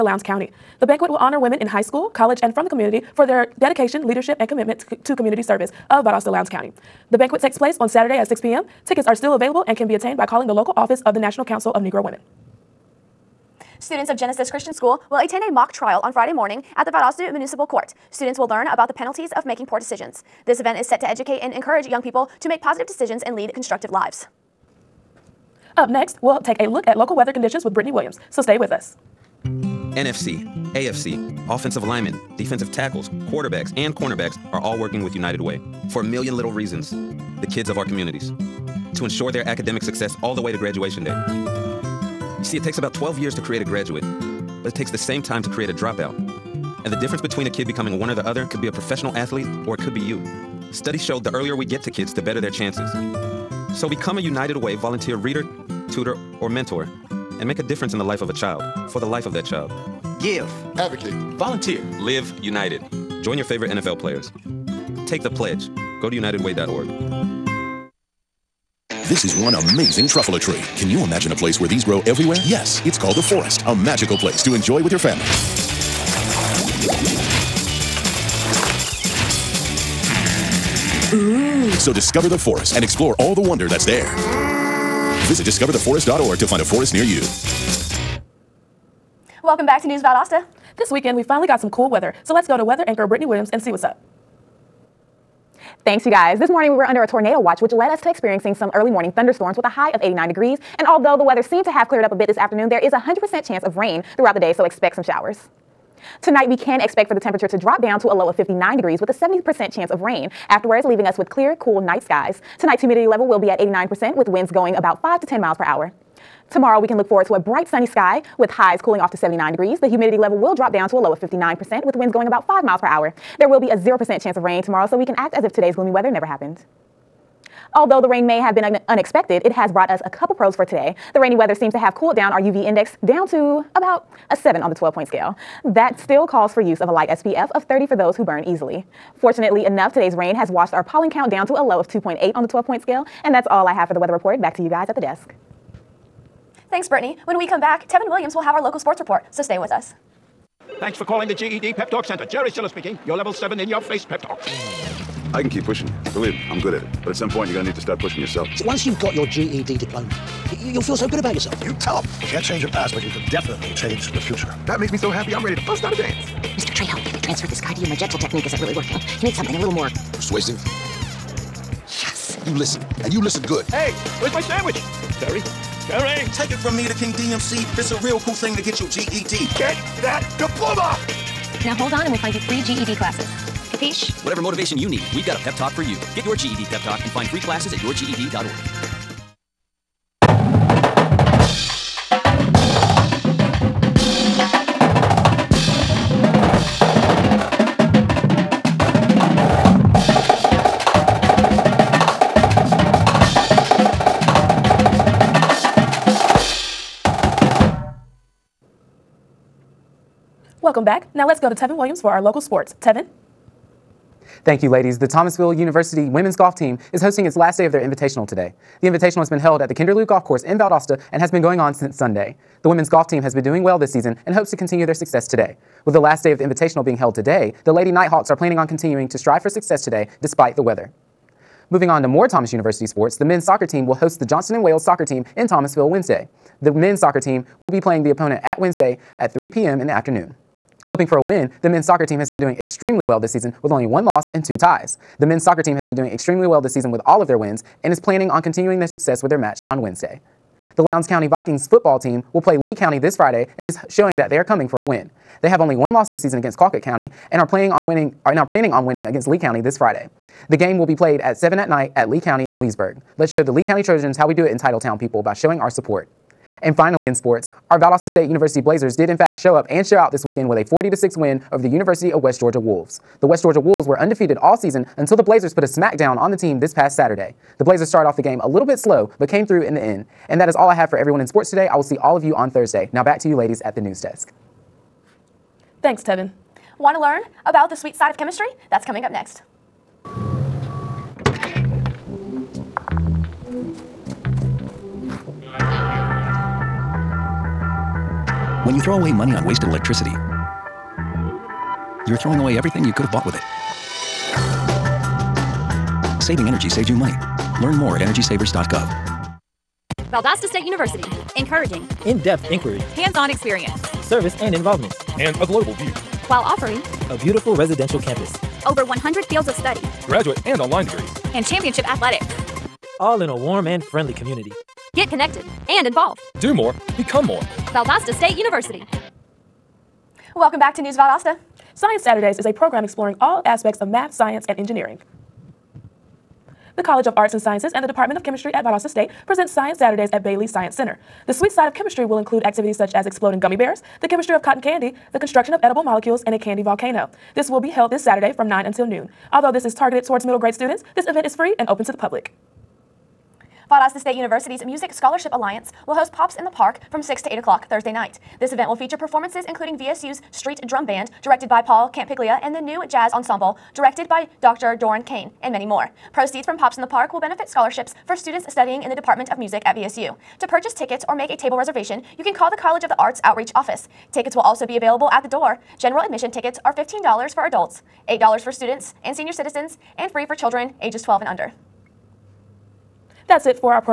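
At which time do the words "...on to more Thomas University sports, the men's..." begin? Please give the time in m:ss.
3:51.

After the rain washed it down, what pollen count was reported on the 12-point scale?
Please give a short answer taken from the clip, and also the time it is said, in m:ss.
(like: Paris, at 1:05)
2.8, at 2:21.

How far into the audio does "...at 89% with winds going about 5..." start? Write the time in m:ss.
1:53.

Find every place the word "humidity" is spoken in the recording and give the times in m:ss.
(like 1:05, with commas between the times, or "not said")
1:52, 1:59.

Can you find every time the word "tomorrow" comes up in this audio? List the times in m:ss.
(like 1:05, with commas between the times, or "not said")
1:56, 2:04.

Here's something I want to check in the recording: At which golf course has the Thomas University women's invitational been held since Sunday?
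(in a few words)
Kinderlou Golf Course.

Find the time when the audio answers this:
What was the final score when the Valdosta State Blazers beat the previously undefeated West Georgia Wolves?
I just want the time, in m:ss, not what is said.
4:30.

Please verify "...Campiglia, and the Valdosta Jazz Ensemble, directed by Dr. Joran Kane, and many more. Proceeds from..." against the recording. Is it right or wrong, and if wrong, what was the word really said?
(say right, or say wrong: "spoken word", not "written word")
wrong: "New", not "Valdosta".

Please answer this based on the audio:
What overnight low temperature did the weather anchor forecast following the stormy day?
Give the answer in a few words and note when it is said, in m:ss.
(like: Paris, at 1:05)
59 degrees, at 1:48.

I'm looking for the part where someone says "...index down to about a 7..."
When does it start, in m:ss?
2:12.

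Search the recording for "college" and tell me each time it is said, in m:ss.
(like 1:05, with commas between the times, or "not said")
0:02, 5:36, 6:12.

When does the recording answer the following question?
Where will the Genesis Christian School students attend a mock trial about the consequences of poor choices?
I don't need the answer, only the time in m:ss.
0:16.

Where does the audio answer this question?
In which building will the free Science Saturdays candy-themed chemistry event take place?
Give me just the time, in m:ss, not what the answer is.
5:40.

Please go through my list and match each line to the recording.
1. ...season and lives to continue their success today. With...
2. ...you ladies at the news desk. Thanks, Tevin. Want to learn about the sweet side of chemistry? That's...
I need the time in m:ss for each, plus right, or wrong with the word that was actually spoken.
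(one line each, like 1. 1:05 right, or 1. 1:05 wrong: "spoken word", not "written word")
1. 3:43 wrong: "hopes", not "lives"
2. 4:43 right.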